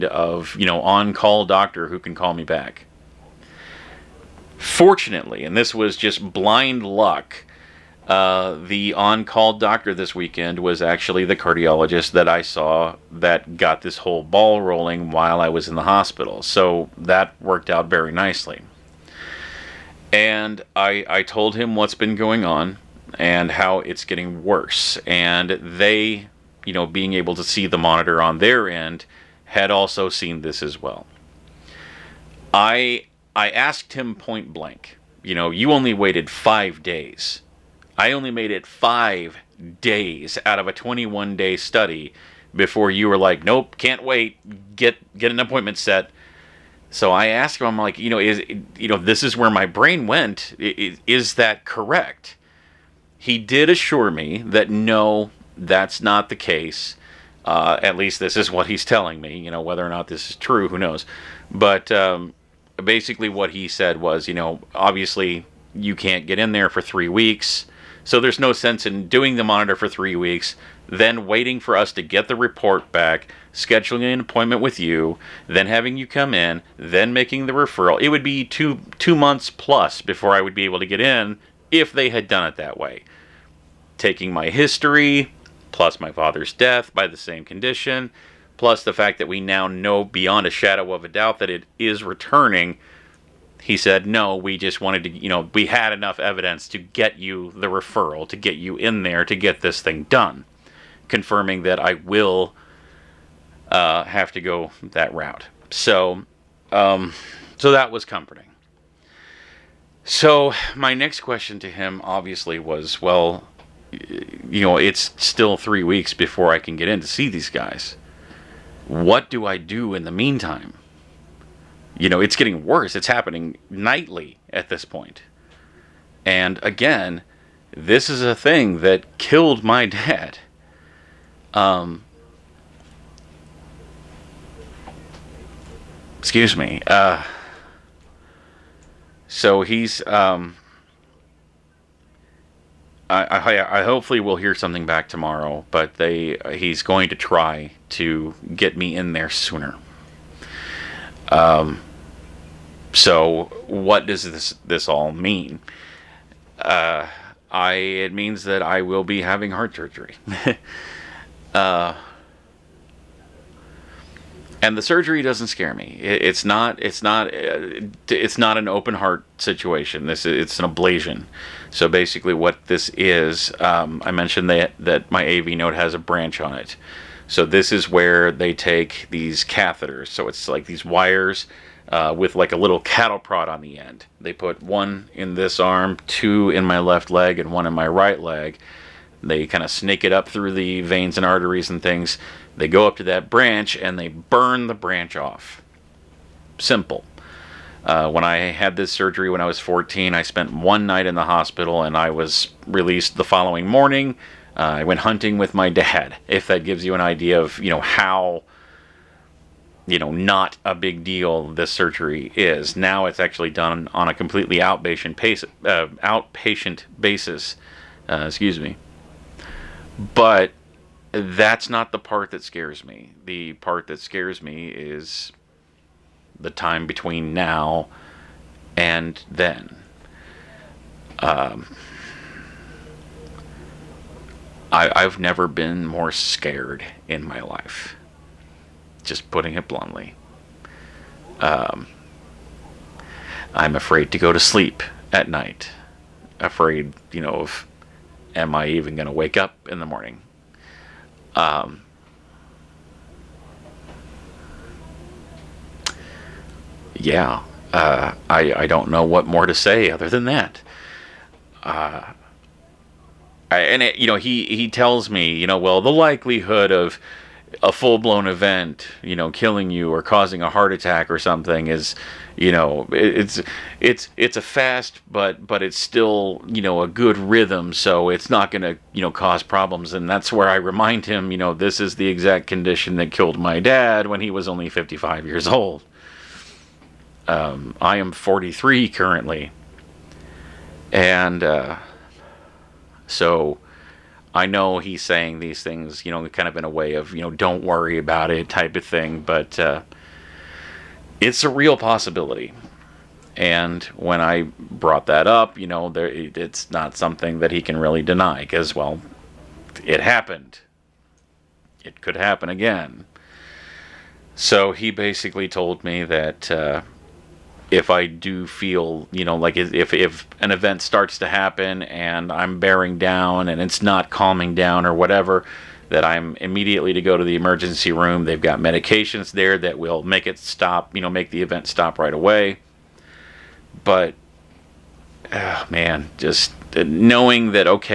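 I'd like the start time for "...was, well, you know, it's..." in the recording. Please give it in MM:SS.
01:52.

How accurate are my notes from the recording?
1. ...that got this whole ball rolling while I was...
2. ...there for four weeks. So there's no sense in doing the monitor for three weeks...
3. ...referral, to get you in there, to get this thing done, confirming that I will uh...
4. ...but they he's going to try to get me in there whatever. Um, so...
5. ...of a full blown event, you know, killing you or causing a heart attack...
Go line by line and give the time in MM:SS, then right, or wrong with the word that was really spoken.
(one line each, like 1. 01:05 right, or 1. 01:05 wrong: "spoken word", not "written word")
1. 00:13 right
2. 01:06 wrong: "three", not "four"
3. 01:37 right
4. 02:25 wrong: "sooner", not "whatever"
5. 04:26 right.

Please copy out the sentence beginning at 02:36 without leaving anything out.
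Uh, I it means that I will be having heart surgery.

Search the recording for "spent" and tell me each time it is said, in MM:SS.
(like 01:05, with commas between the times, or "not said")
03:20.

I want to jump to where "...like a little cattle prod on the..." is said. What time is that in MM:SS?
03:02.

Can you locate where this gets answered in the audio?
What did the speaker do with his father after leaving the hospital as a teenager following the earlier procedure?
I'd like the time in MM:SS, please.
03:25.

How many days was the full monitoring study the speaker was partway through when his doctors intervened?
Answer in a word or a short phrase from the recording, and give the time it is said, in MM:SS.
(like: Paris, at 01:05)
21, at 00:40.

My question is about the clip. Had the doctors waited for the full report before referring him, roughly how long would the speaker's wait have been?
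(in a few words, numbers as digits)
2 months plus.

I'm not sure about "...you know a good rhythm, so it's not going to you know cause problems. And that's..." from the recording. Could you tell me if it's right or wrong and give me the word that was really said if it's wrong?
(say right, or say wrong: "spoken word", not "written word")
right.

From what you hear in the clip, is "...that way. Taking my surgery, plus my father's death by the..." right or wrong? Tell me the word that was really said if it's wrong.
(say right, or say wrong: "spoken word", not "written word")
wrong: "history", not "surgery".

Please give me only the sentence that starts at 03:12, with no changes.
They go up to that branch and they burn the branch off.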